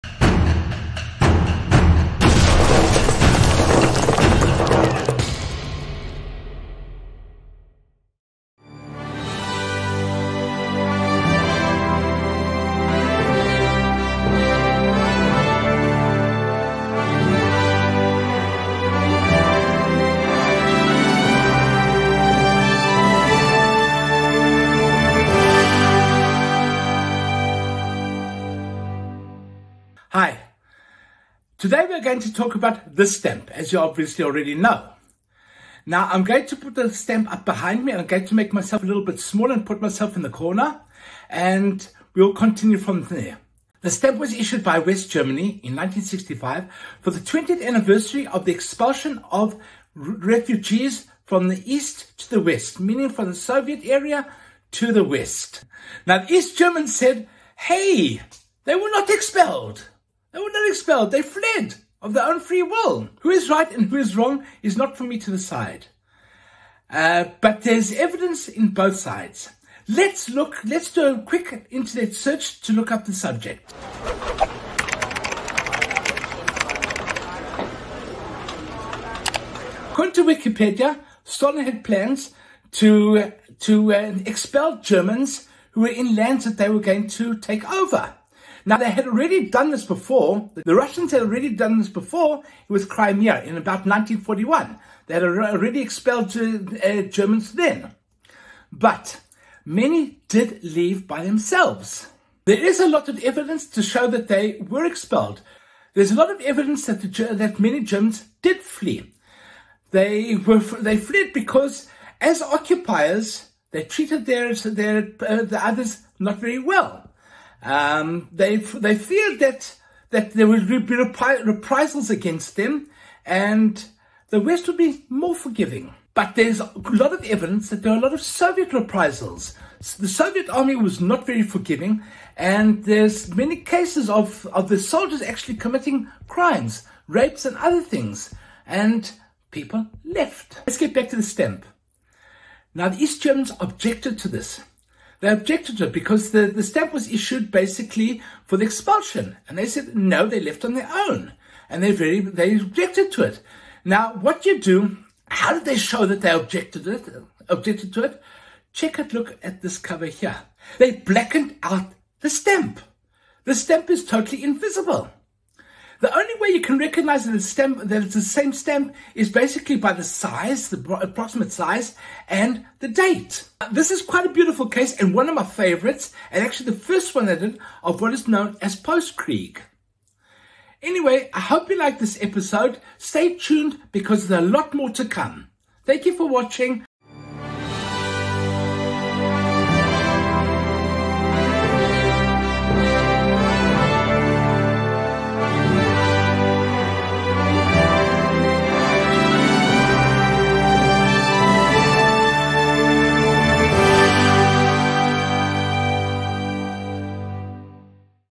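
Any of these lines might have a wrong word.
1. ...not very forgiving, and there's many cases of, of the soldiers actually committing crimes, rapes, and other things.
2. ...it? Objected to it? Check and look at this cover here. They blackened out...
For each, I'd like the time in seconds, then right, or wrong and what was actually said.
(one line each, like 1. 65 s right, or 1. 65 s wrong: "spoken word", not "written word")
1. 130 s right
2. 156 s right.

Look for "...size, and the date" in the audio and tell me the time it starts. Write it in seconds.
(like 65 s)
171 s.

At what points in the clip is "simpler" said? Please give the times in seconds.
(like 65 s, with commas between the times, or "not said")
not said.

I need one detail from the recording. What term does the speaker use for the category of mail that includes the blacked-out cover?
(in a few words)
post-Krieg.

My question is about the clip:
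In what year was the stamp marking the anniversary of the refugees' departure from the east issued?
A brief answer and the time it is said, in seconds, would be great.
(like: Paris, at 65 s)
1965, at 45 s.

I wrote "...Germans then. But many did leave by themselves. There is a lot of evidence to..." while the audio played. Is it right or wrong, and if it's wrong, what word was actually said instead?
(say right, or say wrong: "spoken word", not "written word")
right.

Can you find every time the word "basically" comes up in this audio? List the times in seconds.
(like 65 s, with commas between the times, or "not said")
147 s, 169 s.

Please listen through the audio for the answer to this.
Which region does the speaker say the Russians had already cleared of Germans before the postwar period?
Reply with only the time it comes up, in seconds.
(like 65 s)
92 s.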